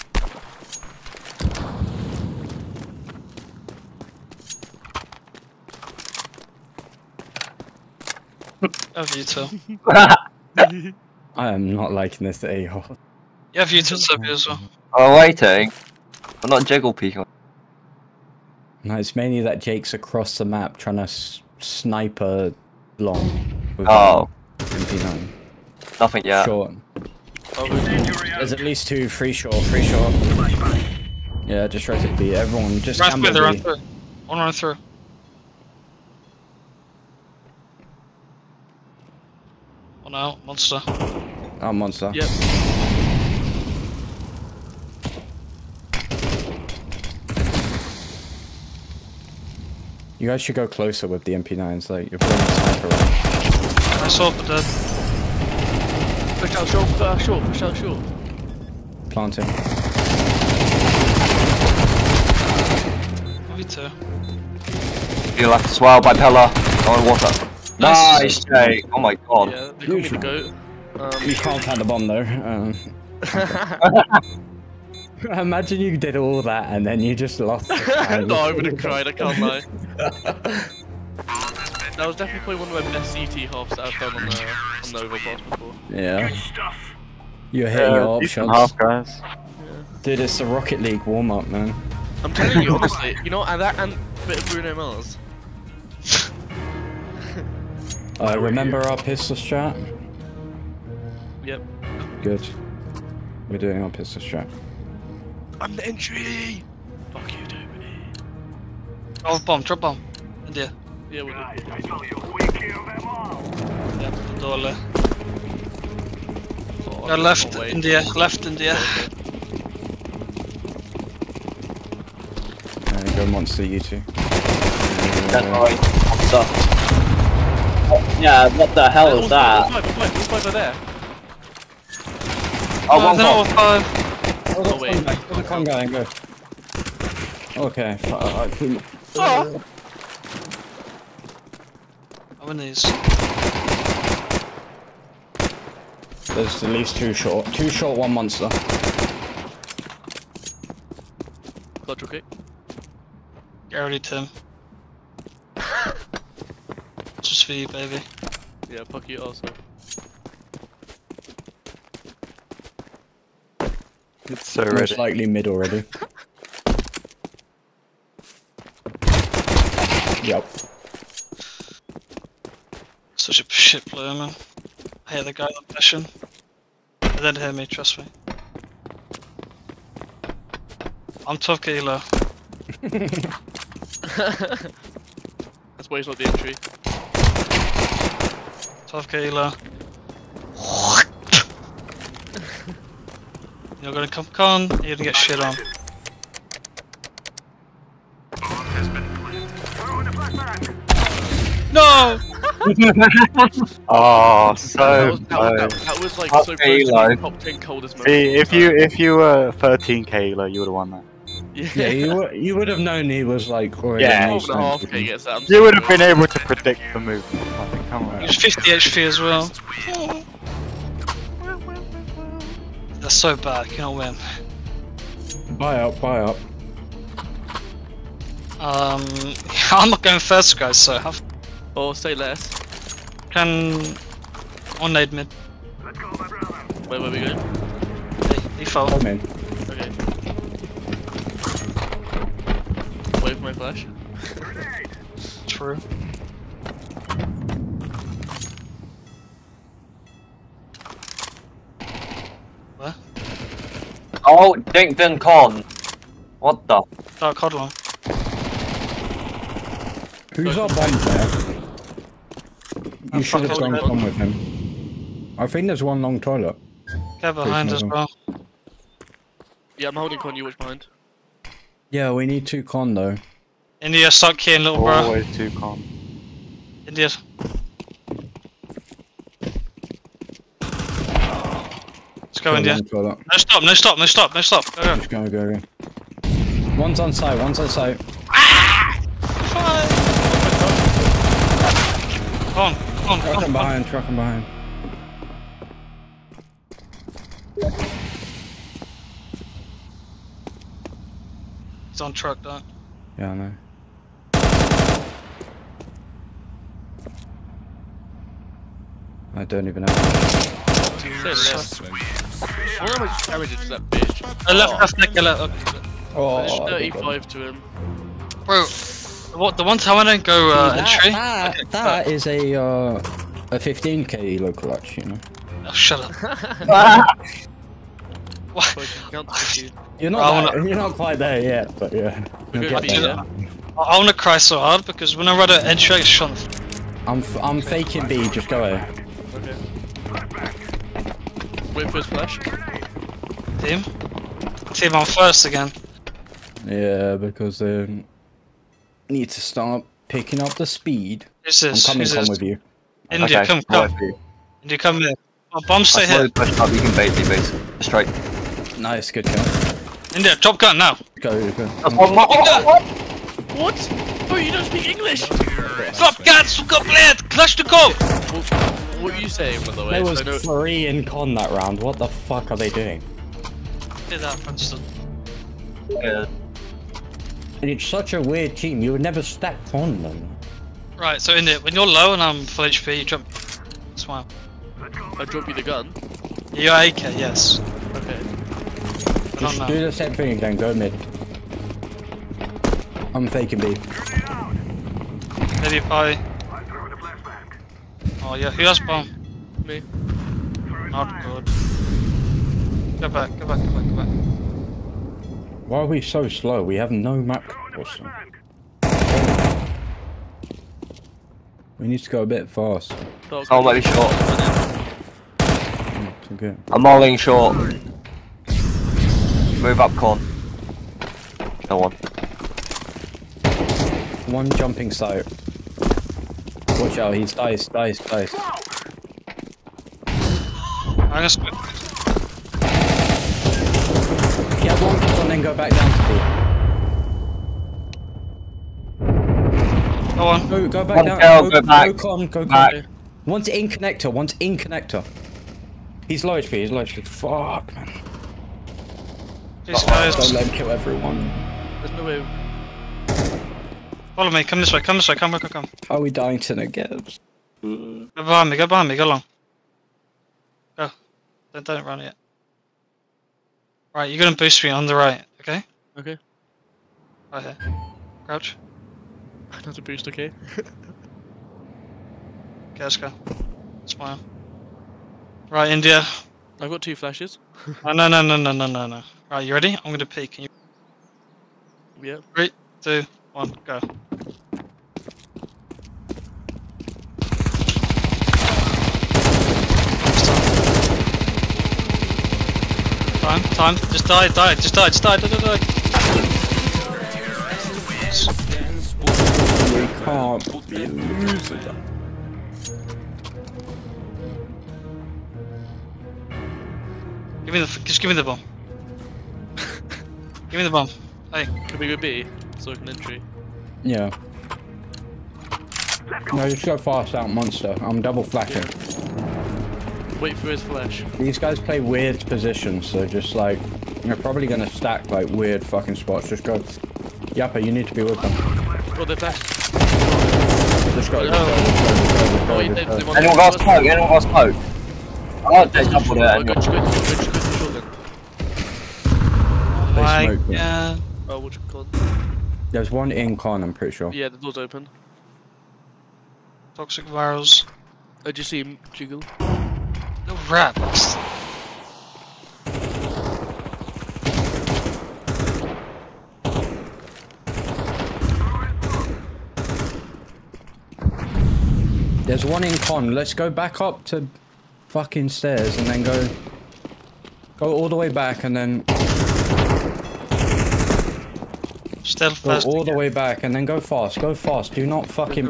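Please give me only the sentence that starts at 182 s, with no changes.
That's why he's not the entry.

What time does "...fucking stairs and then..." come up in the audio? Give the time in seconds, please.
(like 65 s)
564 s.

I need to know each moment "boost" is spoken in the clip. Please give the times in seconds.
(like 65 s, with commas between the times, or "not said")
464 s, 469 s.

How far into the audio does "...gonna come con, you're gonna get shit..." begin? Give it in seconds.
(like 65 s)
193 s.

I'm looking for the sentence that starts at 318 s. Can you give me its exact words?
Bro, what the one time I don't go uh, that, entry?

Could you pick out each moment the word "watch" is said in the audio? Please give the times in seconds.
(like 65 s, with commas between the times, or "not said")
270 s, 426 s.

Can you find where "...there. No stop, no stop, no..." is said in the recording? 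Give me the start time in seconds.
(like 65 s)
282 s.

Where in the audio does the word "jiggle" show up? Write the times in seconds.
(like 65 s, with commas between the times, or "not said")
16 s, 548 s.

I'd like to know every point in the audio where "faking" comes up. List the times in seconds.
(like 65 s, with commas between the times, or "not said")
337 s, 393 s.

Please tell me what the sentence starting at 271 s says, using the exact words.
Yeah, we need two con though.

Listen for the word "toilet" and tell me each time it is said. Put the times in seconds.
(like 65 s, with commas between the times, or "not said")
266 s.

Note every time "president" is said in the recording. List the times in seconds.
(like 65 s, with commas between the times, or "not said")
not said.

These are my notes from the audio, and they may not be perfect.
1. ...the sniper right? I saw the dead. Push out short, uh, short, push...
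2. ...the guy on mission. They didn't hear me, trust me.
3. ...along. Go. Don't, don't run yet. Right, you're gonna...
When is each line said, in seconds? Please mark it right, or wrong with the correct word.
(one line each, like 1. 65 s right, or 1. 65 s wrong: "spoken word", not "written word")
1. 52 s right
2. 175 s right
3. 459 s right.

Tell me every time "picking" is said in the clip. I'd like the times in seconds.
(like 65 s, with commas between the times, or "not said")
350 s.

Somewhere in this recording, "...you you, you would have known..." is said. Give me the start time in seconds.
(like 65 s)
211 s.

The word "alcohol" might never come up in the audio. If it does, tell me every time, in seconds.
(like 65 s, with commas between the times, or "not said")
not said.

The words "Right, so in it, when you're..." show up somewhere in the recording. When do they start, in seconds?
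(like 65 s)
380 s.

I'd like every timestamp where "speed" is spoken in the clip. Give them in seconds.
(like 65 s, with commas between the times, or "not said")
350 s.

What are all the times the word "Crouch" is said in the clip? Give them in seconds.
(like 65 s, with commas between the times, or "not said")
468 s.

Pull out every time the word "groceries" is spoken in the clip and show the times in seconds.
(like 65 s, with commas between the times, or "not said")
not said.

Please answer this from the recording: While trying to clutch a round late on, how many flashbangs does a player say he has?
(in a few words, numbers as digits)
2.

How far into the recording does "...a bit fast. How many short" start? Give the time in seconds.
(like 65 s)
412 s.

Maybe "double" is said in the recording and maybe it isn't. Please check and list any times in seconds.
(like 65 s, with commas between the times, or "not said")
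518 s, 535 s.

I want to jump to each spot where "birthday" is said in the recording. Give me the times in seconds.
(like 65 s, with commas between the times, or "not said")
not said.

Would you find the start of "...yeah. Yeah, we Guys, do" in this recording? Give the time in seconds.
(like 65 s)
110 s.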